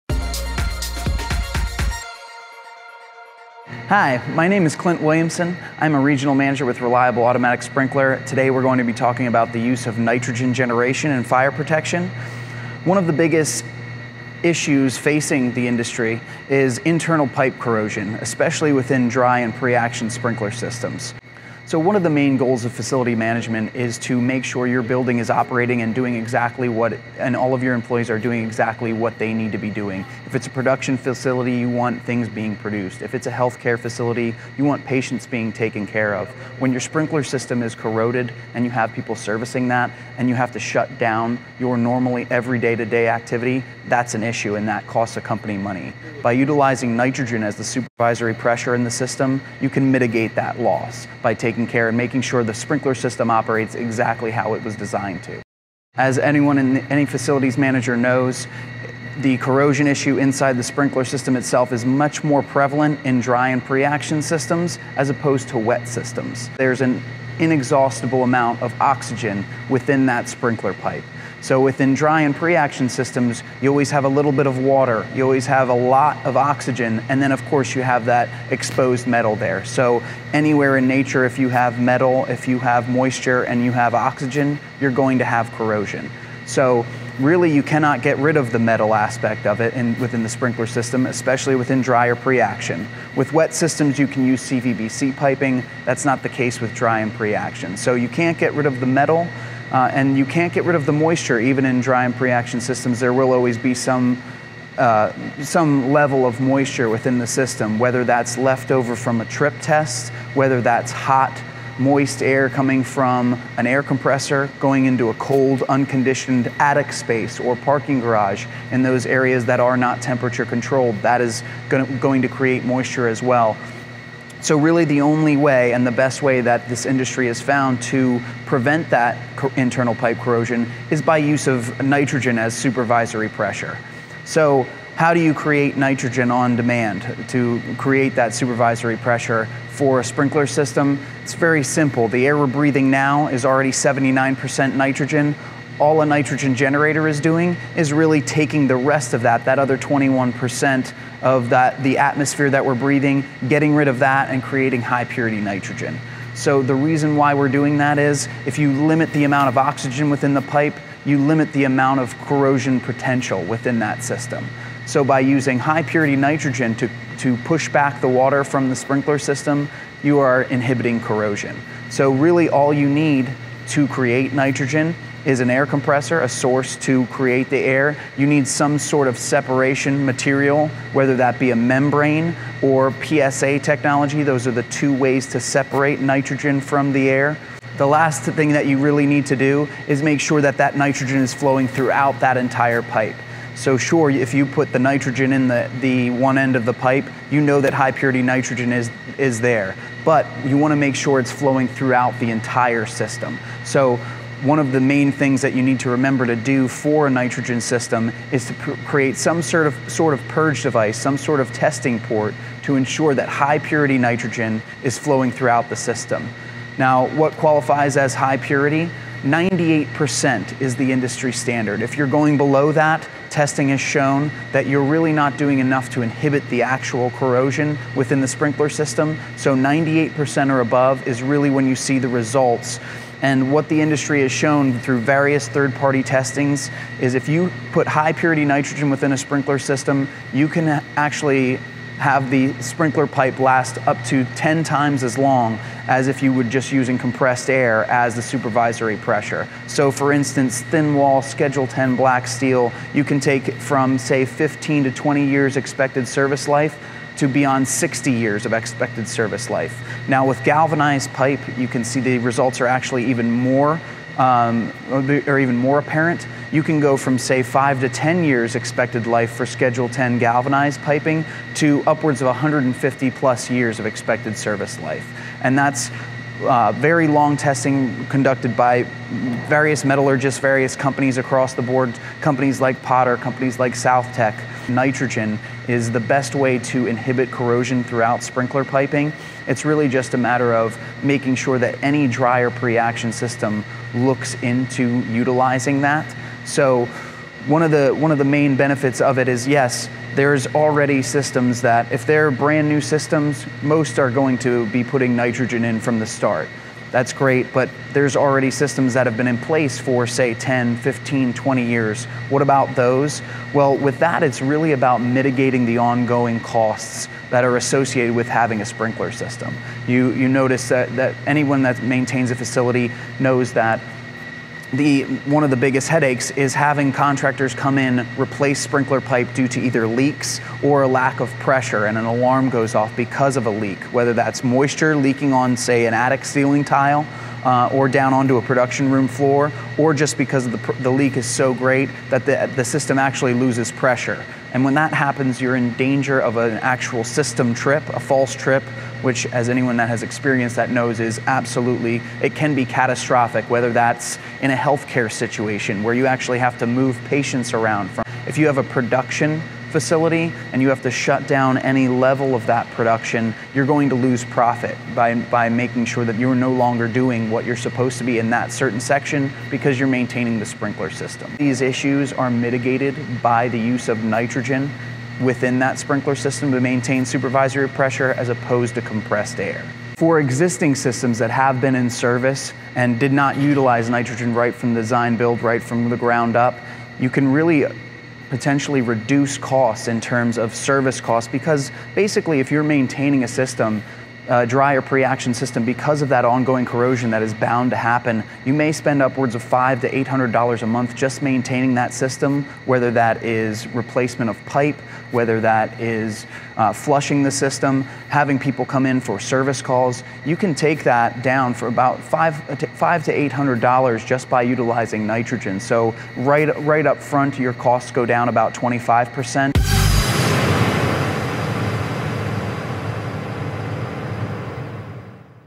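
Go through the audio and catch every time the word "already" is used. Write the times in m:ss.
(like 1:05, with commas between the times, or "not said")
2:23, 5:00, 5:08.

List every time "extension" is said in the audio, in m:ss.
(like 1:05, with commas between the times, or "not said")
not said.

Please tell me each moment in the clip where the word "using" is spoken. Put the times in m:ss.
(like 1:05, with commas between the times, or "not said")
2:45, 4:06.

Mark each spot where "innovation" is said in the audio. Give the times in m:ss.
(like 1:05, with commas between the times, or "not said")
not said.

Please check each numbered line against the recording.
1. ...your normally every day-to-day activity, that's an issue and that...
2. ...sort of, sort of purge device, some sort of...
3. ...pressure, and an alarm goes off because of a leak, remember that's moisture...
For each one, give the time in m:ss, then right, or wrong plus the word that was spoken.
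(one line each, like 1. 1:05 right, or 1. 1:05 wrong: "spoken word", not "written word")
1. 0:41 right
2. 3:29 right
3. 5:31 wrong: "whether", not "remember".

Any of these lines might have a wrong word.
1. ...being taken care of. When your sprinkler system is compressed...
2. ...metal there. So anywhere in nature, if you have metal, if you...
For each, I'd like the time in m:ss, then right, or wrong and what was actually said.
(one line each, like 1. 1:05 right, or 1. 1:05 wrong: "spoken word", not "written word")
1. 0:35 wrong: "corroded", not "compressed"
2. 1:19 right.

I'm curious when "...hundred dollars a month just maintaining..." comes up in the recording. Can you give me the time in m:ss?
6:40.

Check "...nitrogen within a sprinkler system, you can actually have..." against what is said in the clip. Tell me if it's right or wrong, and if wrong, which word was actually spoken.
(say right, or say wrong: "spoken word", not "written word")
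right.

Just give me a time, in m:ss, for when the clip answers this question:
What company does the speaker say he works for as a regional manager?
0:06.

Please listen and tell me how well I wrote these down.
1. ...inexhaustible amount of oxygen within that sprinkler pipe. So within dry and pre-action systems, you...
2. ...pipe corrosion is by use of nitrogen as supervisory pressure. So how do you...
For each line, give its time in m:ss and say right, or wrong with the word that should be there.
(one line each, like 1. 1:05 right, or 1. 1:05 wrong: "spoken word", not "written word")
1. 1:07 right
2. 2:09 right.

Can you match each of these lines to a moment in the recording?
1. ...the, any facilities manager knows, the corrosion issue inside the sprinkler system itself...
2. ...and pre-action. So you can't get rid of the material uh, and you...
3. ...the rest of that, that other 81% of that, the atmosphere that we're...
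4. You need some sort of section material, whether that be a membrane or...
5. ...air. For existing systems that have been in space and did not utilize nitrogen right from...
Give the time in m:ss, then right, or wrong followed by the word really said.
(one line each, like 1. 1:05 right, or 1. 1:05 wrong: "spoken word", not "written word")
1. 0:56 right
2. 1:36 wrong: "metal", not "material"
3. 2:28 wrong: "21", not "81"
4. 2:58 wrong: "separation", not "section"
5. 6:19 wrong: "service", not "space".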